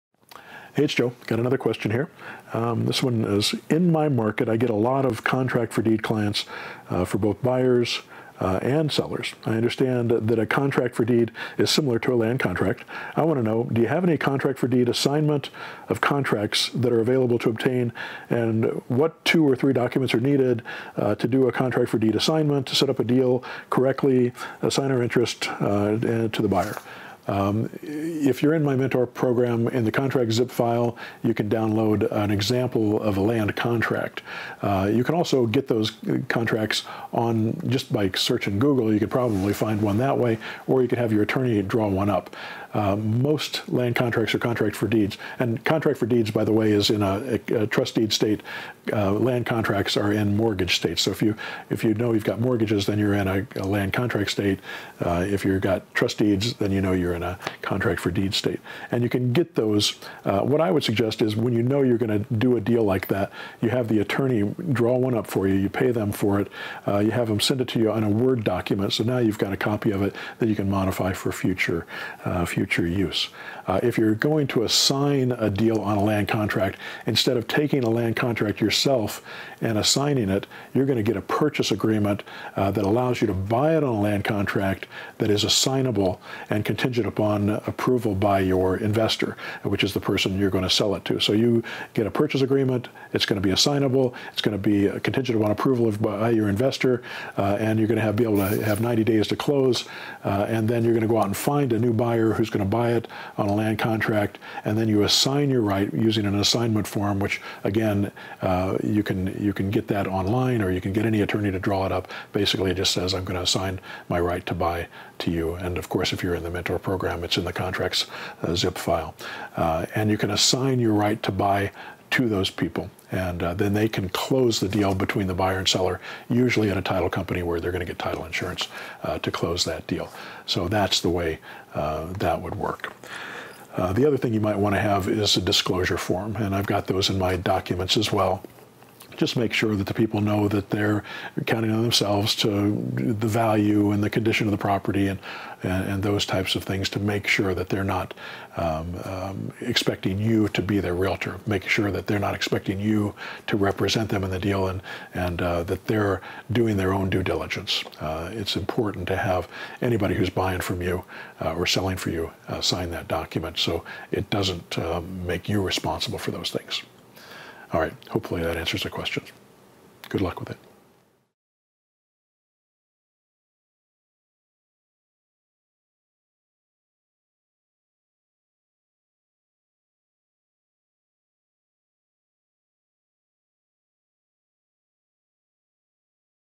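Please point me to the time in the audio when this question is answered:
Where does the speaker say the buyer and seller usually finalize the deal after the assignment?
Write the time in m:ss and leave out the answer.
2:06.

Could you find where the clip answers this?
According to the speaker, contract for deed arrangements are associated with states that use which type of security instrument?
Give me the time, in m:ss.
0:47.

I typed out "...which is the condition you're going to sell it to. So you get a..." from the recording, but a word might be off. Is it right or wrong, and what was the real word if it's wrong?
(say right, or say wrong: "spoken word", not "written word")
wrong: "person", not "condition".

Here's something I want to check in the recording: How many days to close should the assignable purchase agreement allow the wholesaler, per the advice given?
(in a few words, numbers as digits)
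90.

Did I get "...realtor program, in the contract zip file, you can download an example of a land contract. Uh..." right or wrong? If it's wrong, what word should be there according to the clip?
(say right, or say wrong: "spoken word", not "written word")
wrong: "mentor", not "realtor".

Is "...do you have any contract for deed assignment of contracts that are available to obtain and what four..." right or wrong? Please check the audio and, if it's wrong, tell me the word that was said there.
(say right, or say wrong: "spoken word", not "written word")
wrong: "two", not "four".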